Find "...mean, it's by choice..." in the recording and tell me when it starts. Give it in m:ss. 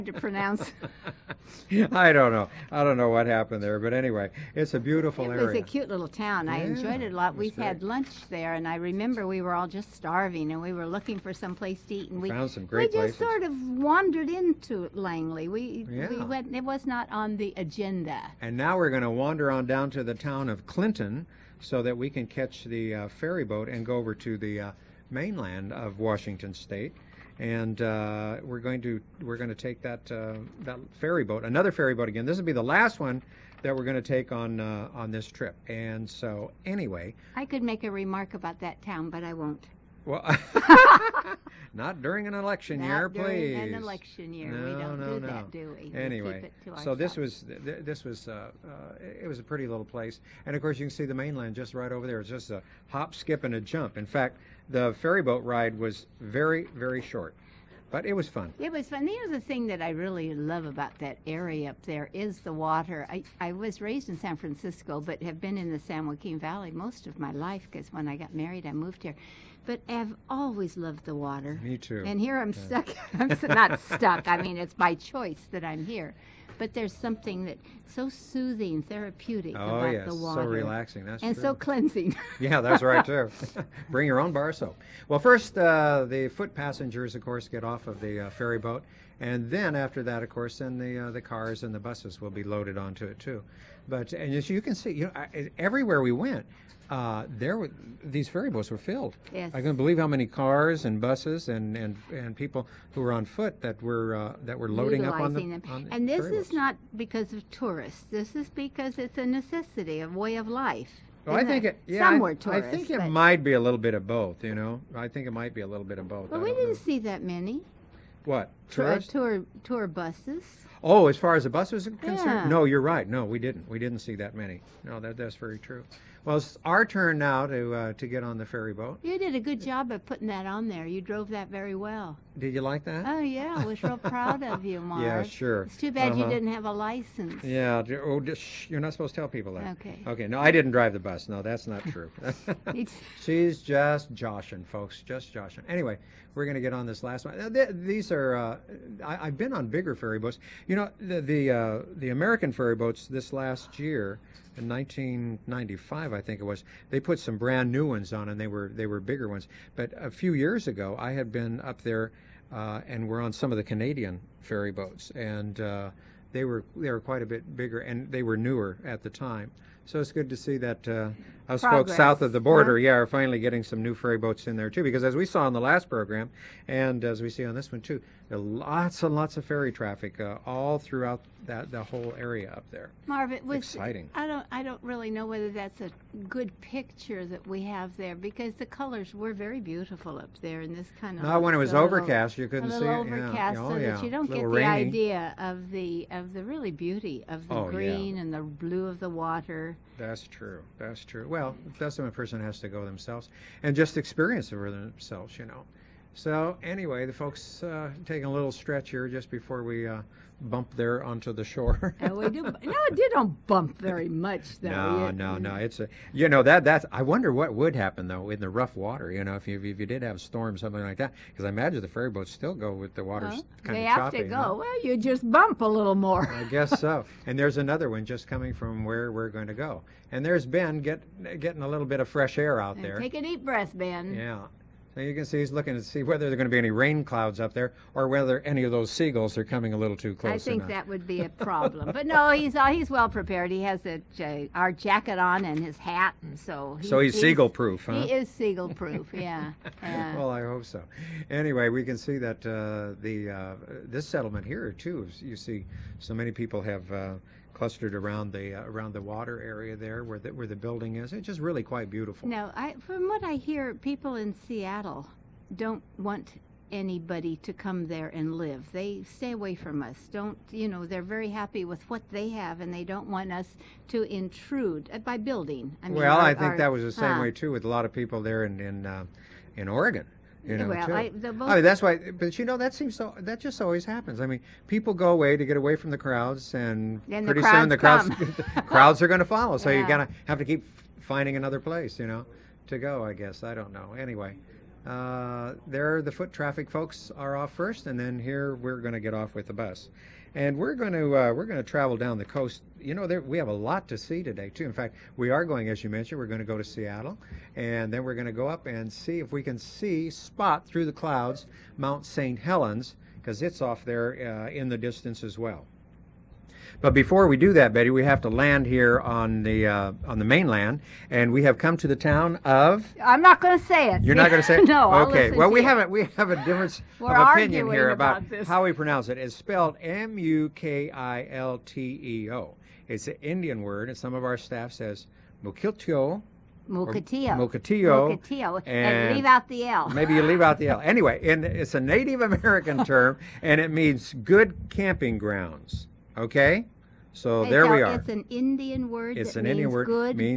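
1:14.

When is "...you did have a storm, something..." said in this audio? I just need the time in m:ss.
3:39.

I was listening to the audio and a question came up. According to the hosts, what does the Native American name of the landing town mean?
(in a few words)
good camping grounds.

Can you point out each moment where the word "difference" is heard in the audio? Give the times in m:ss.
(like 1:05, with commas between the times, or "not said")
5:26.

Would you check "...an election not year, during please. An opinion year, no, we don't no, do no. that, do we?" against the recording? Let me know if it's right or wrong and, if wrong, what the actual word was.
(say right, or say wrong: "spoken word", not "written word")
wrong: "election", not "opinion".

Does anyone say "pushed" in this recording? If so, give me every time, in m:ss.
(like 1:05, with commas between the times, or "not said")
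not said.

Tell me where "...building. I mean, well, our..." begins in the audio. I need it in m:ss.
4:35.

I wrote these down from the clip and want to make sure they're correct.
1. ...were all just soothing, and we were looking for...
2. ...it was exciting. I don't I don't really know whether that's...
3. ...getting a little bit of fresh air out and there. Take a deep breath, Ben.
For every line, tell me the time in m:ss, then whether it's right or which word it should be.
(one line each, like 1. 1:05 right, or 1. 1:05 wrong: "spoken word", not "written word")
1. 0:09 wrong: "starving", not "soothing"
2. 3:03 right
3. 3:51 right.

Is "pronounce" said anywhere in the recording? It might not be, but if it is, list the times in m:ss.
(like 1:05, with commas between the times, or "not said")
0:00, 5:28.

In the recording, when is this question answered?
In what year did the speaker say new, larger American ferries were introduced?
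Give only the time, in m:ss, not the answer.
2:34.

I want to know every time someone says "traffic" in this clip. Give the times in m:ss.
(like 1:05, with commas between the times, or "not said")
2:59, 4:56.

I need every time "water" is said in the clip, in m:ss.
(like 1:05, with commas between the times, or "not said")
1:02, 1:11, 1:20, 3:19, 3:38, 3:43, 4:19.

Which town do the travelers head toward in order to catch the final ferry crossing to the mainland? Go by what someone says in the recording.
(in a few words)
Clinton.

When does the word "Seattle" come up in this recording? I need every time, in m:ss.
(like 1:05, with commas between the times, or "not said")
4:24, 5:06.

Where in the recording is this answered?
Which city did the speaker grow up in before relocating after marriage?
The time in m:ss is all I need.
1:04.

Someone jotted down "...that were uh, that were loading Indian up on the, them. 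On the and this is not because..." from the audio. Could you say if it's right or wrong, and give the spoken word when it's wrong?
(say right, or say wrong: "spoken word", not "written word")
wrong: "Utilizing", not "Indian".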